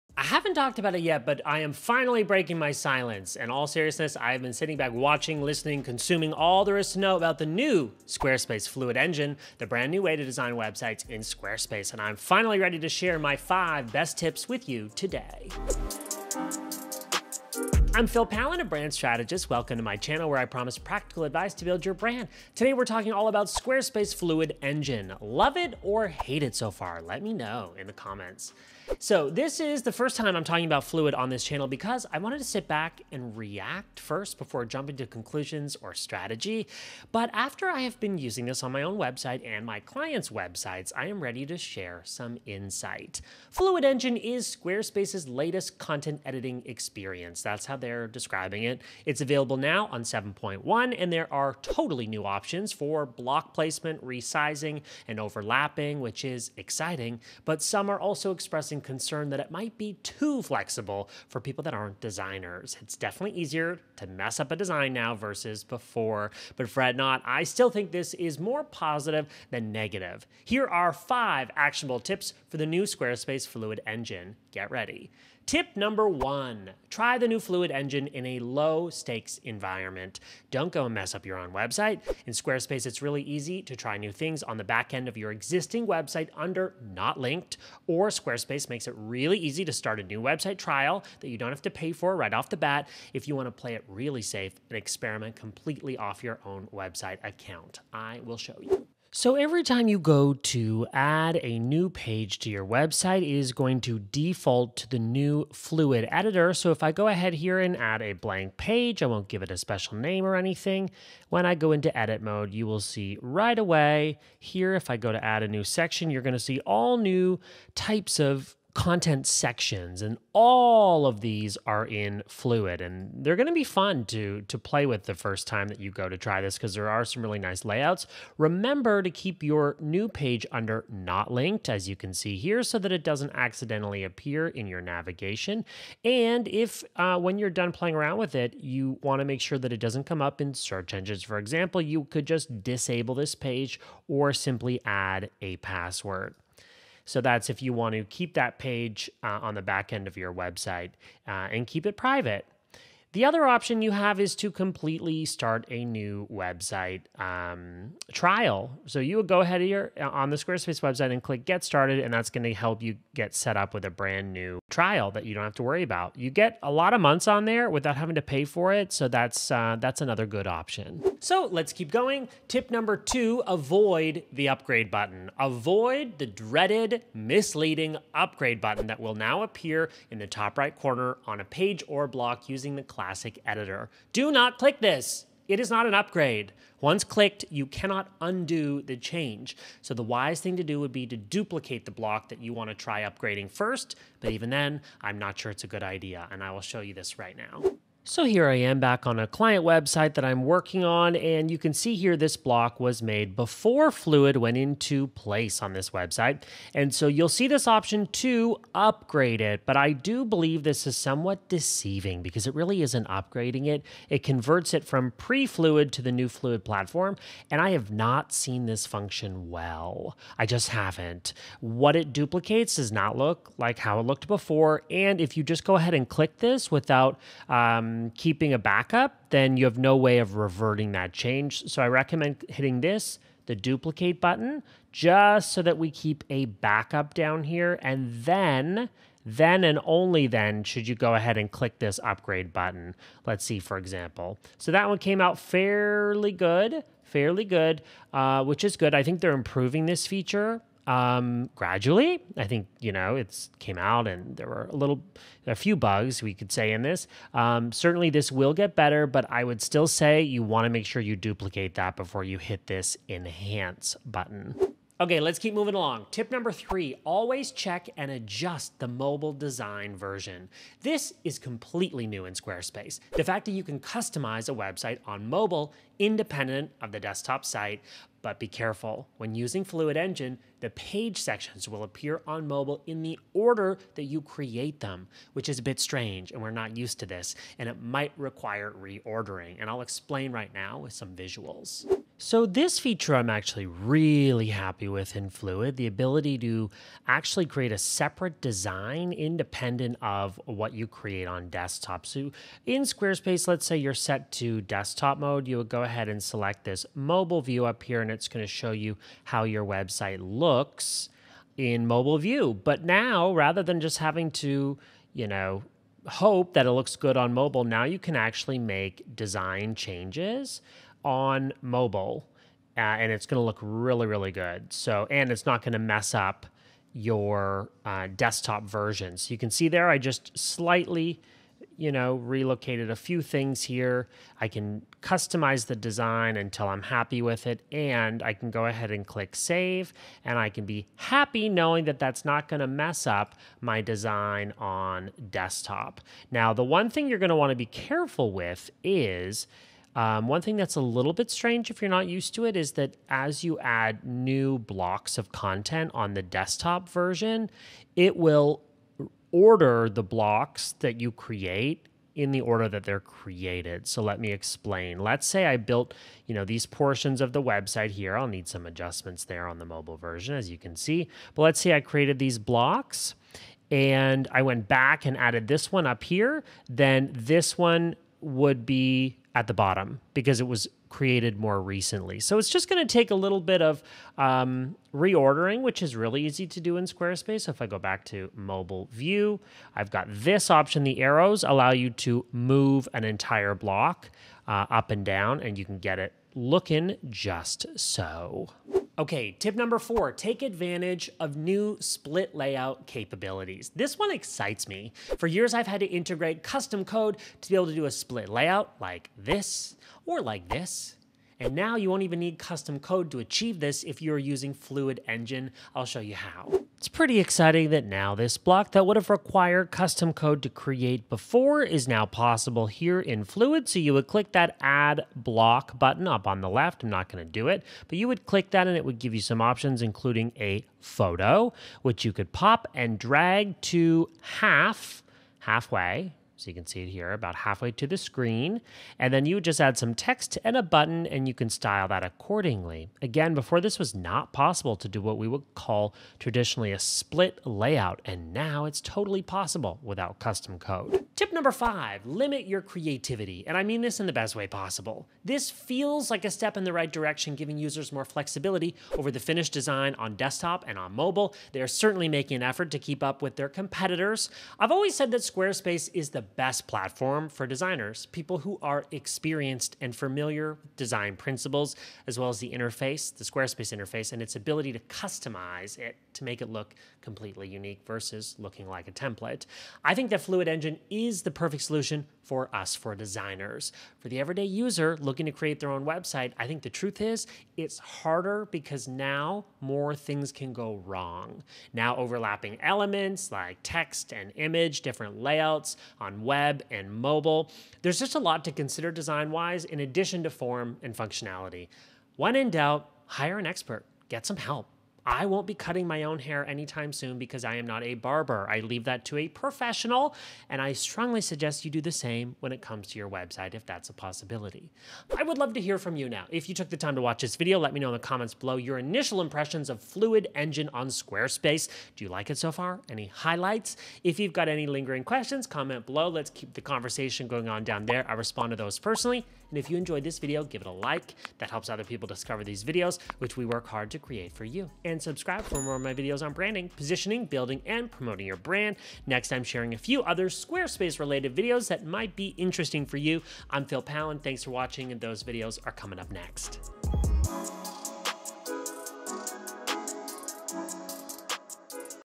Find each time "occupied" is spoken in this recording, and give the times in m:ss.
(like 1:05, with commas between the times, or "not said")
not said.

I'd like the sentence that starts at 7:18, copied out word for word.
And then you would just add some text and a button and you can style that accordingly.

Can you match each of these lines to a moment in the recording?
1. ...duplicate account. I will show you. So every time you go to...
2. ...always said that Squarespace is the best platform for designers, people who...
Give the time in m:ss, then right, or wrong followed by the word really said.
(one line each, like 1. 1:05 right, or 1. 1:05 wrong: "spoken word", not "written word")
1. 1:36 wrong: "website", not "duplicate"
2. 7:44 right.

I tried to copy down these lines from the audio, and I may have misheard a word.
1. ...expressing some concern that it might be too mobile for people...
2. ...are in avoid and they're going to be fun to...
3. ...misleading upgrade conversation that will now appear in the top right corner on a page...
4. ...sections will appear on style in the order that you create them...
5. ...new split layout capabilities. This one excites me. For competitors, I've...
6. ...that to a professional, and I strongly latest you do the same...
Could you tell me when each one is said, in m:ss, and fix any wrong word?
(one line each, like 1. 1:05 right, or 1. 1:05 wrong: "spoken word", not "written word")
1. 0:58 wrong: "flexible", not "mobile"
2. 2:01 wrong: "fluid", not "avoid"
3. 2:57 wrong: "button", not "conversation"
4. 4:41 wrong: "mobile", not "style"
5. 6:41 wrong: "years", not "competitors"
6. 8:28 wrong: "suggest", not "latest".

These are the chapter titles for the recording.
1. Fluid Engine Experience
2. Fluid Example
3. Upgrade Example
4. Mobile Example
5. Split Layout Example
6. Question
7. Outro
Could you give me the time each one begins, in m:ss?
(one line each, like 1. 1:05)
1. 0:43
2. 1:38
3. 3:16
4. 4:52
5. 6:56
6. 8:34
7. 8:44.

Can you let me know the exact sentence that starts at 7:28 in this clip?
And now it's totally possible without custom code.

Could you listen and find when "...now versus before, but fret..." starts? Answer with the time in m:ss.
1:04.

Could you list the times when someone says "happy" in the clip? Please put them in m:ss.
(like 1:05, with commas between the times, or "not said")
4:54, 5:36, 5:40.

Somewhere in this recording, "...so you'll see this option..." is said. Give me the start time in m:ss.
3:26.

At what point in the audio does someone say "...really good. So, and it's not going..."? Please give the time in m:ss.
5:24.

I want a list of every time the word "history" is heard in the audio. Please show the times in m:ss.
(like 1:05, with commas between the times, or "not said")
not said.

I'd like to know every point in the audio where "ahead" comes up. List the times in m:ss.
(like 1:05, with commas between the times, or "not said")
1:47, 2:39, 3:45, 4:01, 5:05, 5:38.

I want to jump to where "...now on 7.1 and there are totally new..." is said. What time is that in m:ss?
0:49.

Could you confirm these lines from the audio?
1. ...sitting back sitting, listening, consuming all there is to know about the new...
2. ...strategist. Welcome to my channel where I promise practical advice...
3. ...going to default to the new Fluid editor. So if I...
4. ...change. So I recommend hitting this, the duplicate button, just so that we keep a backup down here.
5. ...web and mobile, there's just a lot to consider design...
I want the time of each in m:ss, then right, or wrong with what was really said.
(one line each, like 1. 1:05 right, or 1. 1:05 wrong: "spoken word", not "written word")
1. 0:04 wrong: "watching", not "sitting"
2. 0:18 right
3. 1:43 right
4. 3:51 right
5. 8:16 right.